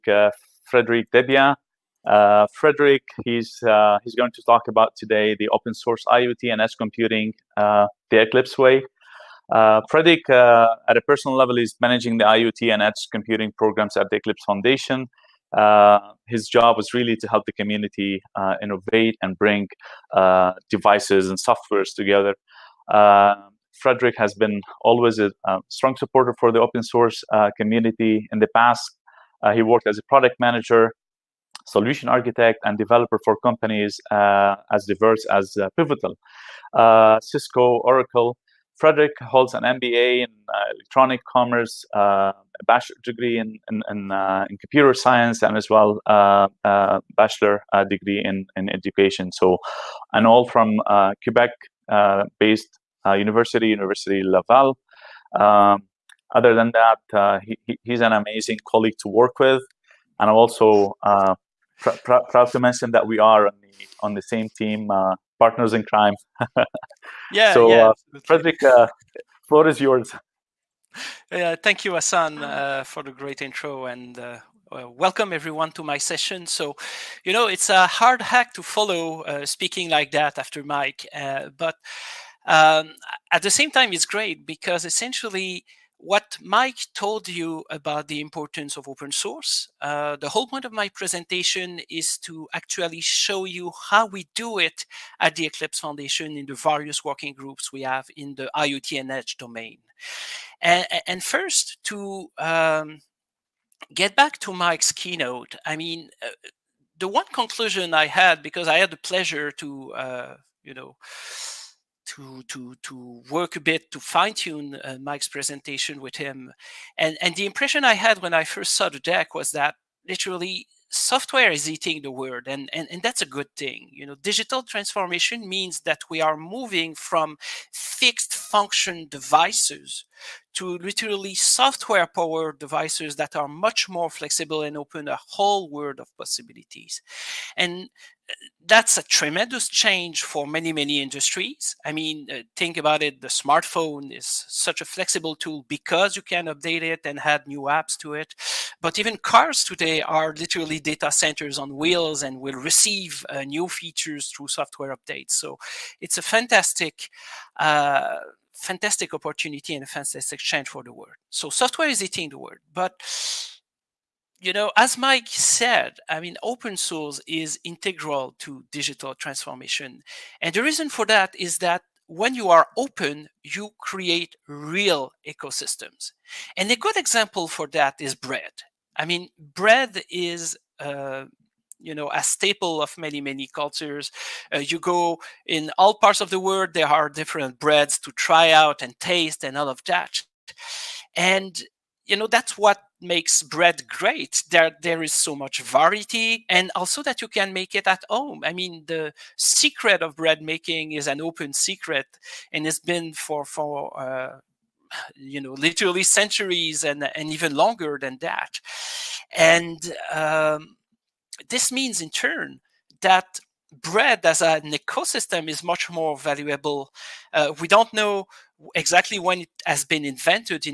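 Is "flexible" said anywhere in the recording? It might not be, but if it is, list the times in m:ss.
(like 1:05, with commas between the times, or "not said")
2:14, 2:24.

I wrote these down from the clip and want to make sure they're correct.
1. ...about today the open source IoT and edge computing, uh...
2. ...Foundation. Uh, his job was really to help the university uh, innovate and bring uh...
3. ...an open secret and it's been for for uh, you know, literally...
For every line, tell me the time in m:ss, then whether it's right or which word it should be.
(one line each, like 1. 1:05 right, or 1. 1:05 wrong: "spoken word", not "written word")
1. 0:04 right
2. 0:14 wrong: "community", not "university"
3. 3:21 right.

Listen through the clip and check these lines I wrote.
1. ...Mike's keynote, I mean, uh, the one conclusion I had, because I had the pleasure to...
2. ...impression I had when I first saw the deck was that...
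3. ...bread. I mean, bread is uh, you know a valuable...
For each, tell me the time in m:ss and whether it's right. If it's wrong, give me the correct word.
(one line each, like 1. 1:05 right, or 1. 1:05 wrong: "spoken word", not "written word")
1. 1:44 right
2. 1:57 right
3. 2:58 wrong: "staple", not "valuable".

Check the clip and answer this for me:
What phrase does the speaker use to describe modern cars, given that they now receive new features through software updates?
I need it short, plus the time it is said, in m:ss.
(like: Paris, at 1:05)
data centers on wheels, at 2:30.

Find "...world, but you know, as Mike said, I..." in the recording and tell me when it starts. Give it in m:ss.
2:42.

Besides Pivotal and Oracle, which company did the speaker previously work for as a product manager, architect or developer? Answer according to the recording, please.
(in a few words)
Cisco.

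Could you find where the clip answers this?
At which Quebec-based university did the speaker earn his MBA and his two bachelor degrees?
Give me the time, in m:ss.
0:53.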